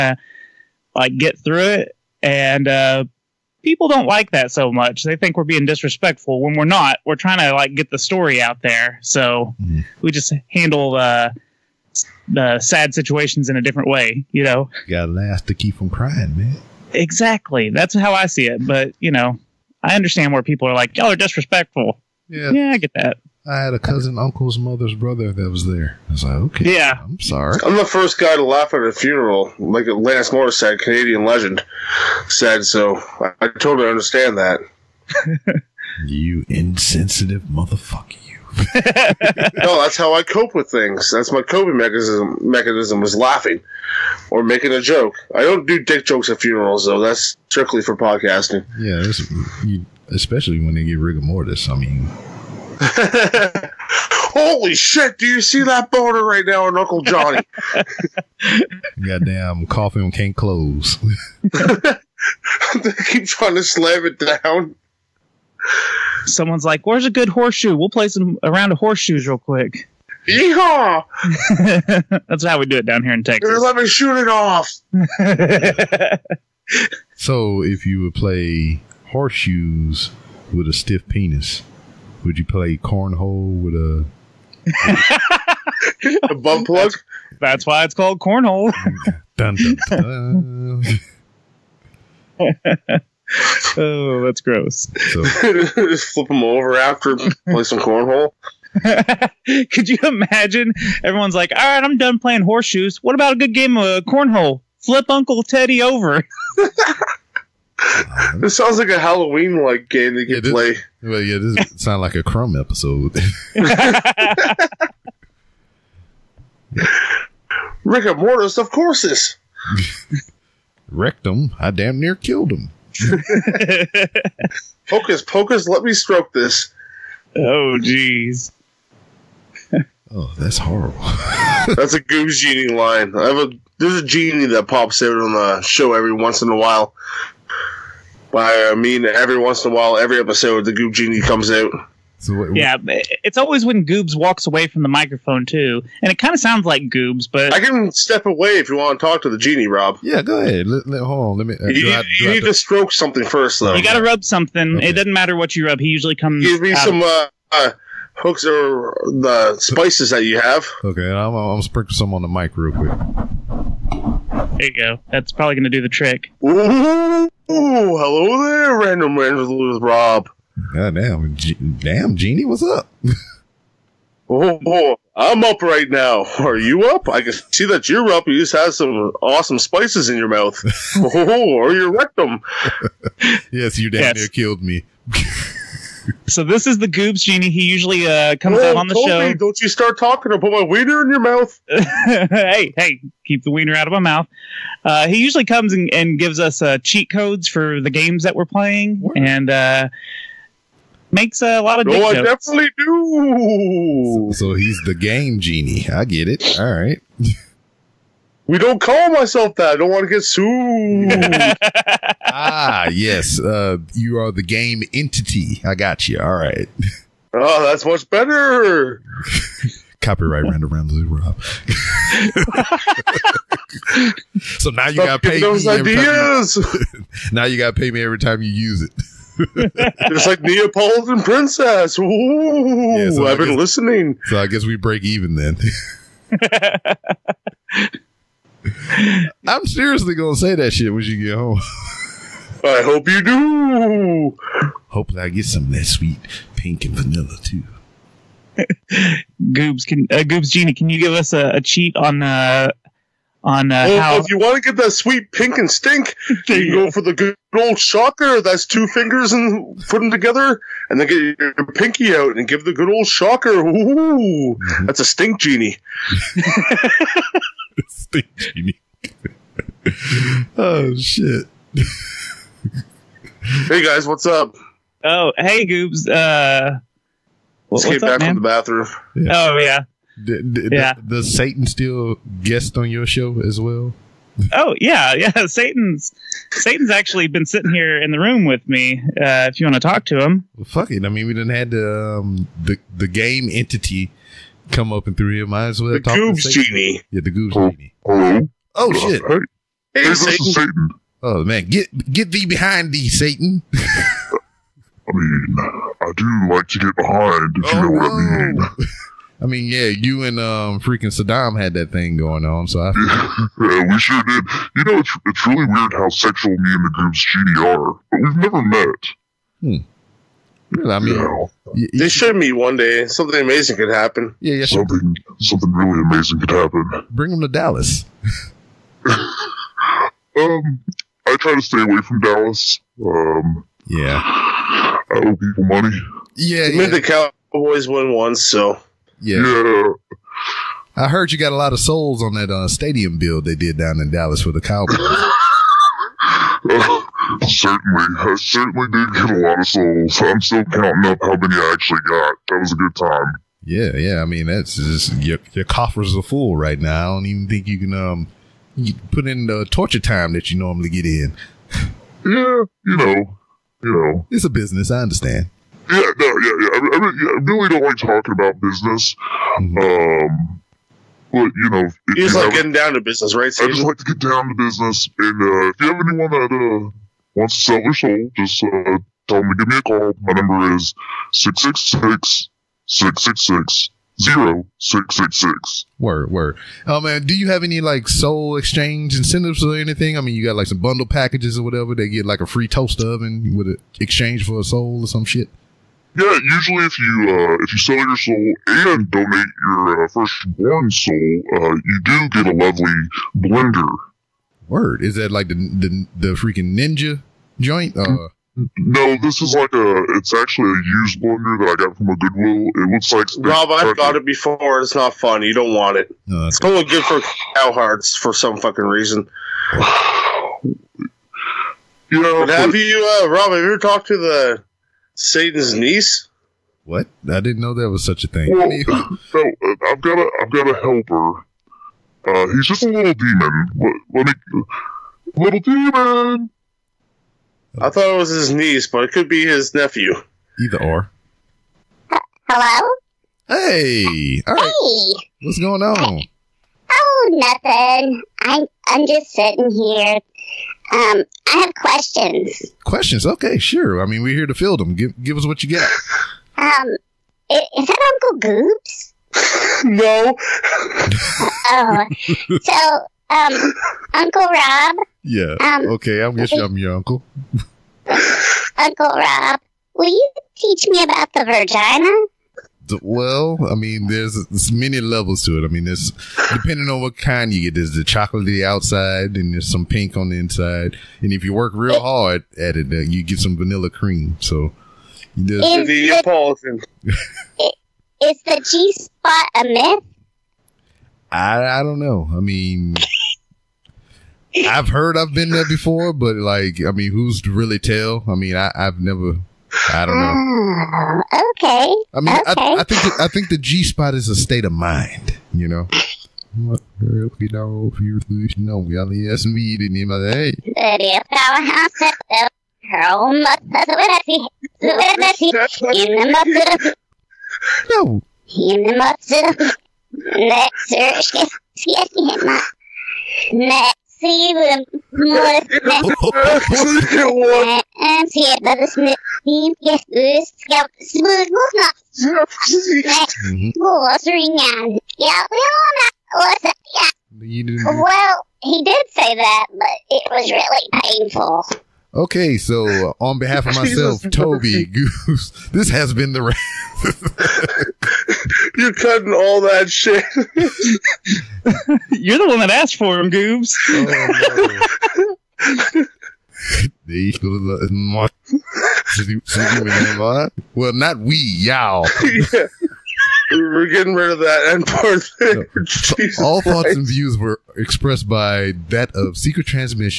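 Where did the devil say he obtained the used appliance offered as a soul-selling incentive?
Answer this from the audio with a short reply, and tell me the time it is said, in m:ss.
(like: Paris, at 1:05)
Goodwill, at 6:52.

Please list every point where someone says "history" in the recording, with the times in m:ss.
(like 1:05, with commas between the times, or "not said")
not said.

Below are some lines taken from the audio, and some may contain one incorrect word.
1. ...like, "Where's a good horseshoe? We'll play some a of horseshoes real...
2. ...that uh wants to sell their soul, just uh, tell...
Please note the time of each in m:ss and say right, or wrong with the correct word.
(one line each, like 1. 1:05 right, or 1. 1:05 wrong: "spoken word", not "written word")
1. 1:06 right
2. 6:16 right.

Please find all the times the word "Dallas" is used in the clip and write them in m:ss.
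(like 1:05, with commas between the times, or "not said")
5:27, 5:32, 5:44.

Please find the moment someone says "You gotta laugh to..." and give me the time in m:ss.
0:14.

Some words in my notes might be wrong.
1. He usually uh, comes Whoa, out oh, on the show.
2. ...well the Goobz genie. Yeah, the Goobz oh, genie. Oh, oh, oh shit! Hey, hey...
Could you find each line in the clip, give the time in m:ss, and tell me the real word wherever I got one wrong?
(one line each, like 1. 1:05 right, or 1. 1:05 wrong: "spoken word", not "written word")
1. 3:07 right
2. 4:55 right.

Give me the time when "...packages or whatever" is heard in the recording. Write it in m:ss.
6:31.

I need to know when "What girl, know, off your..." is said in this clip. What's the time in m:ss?
8:26.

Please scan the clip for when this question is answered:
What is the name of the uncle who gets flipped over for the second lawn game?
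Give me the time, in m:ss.
1:45.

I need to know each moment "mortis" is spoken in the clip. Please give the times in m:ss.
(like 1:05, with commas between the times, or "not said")
0:51, 1:58.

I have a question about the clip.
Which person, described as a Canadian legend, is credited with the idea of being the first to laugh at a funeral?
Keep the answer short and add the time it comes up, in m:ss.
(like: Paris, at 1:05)
Lance Morris, at 0:29.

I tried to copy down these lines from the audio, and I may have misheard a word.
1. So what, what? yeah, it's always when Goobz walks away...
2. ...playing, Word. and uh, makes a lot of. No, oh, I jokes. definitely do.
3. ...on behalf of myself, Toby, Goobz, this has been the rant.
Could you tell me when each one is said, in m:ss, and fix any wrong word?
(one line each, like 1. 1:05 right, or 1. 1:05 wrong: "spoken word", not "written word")
1. 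2:22 right
2. 3:18 right
3. 9:03 right.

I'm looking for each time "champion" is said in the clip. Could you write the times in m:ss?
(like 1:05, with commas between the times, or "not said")
not said.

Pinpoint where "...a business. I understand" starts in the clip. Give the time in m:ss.
6:04.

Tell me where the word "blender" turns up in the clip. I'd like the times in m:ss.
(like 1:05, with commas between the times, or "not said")
6:43, 6:51.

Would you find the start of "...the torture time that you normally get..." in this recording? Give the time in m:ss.
5:59.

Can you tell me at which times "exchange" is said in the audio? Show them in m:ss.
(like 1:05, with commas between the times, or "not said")
6:28, 6:34.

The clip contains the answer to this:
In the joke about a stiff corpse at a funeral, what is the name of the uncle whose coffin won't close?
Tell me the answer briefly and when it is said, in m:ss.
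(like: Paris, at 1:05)
Uncle Johnny, at 0:56.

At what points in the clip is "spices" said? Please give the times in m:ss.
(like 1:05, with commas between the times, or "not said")
2:39, 2:59.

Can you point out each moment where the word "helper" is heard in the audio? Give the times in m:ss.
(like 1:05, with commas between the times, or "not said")
7:10.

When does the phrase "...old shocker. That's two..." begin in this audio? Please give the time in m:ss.
4:17.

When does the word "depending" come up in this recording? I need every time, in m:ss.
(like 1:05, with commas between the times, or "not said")
7:56.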